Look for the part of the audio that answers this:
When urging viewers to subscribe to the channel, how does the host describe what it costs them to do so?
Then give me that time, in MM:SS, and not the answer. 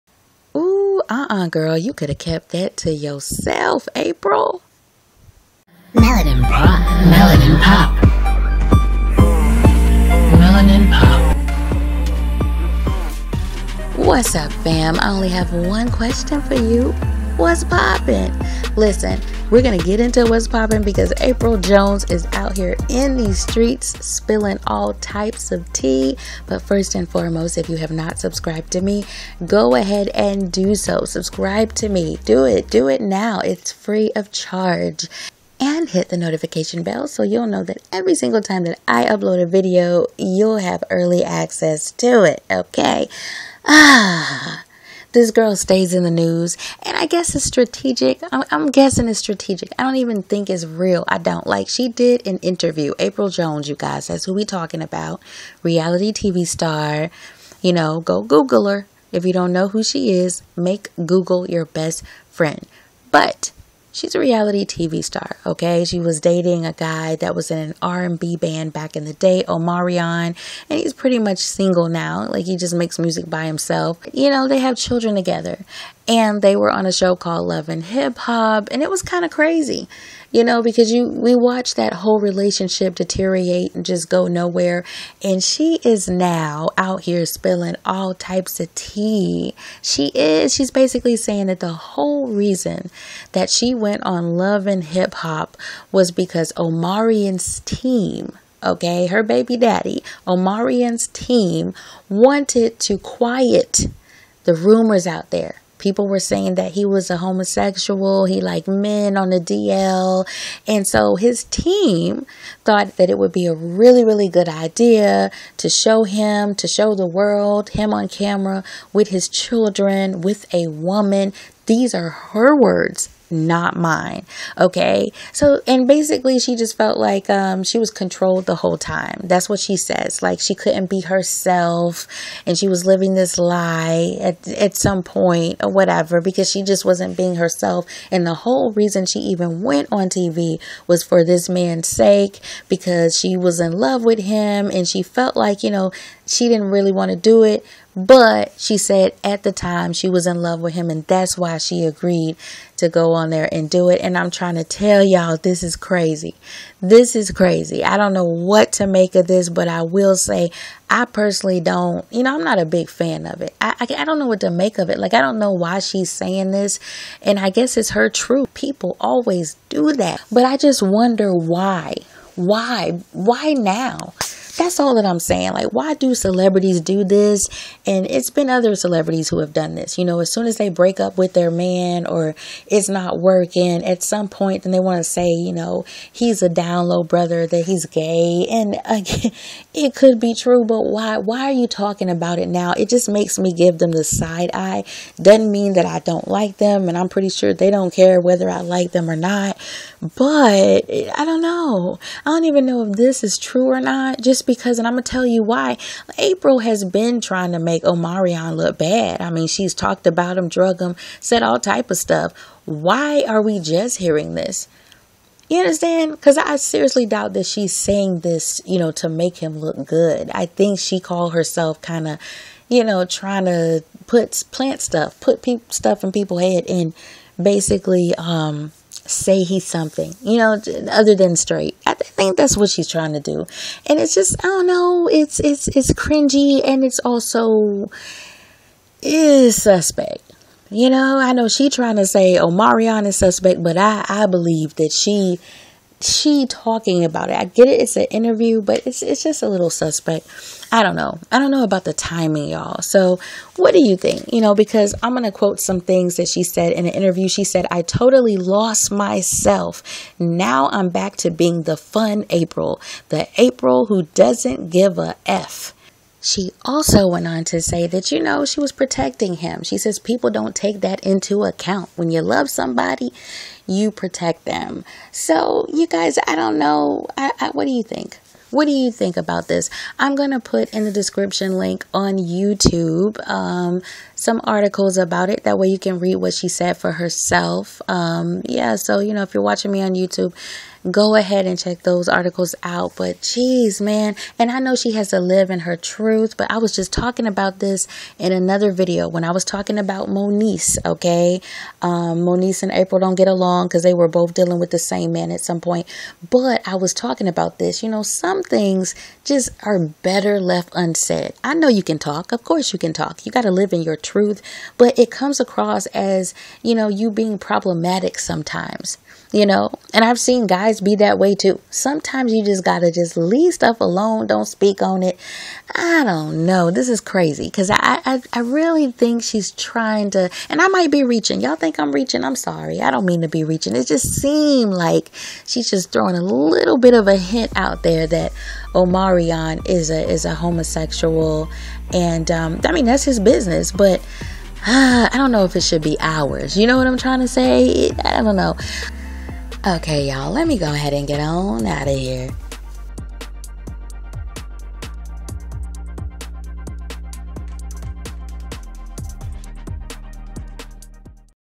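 00:33.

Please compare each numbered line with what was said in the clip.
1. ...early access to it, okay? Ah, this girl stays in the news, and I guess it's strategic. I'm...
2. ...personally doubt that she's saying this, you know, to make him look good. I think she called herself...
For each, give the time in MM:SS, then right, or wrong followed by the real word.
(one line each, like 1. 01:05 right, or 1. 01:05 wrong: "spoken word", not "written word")
1. 00:40 right
2. 03:36 wrong: "seriously", not "personally".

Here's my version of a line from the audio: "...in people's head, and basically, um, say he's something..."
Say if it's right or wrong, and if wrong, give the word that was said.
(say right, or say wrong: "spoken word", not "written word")
right.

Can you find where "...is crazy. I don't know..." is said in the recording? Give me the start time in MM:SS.
02:37.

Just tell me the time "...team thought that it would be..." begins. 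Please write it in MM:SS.
01:51.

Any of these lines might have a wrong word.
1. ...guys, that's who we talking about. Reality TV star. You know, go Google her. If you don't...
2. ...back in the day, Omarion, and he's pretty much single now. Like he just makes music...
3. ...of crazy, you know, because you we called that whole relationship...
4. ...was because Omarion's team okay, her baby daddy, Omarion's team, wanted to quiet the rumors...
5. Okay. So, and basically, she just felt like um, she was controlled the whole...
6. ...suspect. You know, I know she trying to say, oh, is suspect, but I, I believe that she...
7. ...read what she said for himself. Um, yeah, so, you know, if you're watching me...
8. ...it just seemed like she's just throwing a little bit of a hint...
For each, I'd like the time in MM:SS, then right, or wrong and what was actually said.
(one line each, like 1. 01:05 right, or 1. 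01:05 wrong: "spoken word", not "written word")
1. 00:53 right
2. 01:08 right
3. 01:19 wrong: "watched", not "called"
4. 01:35 right
5. 02:04 right
6. 03:59 right
7. 04:45 wrong: "herself", not "himself"
8. 05:33 right.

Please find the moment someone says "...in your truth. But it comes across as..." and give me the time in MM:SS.
05:13.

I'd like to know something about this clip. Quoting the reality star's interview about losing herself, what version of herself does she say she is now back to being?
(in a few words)
The fun Apryl.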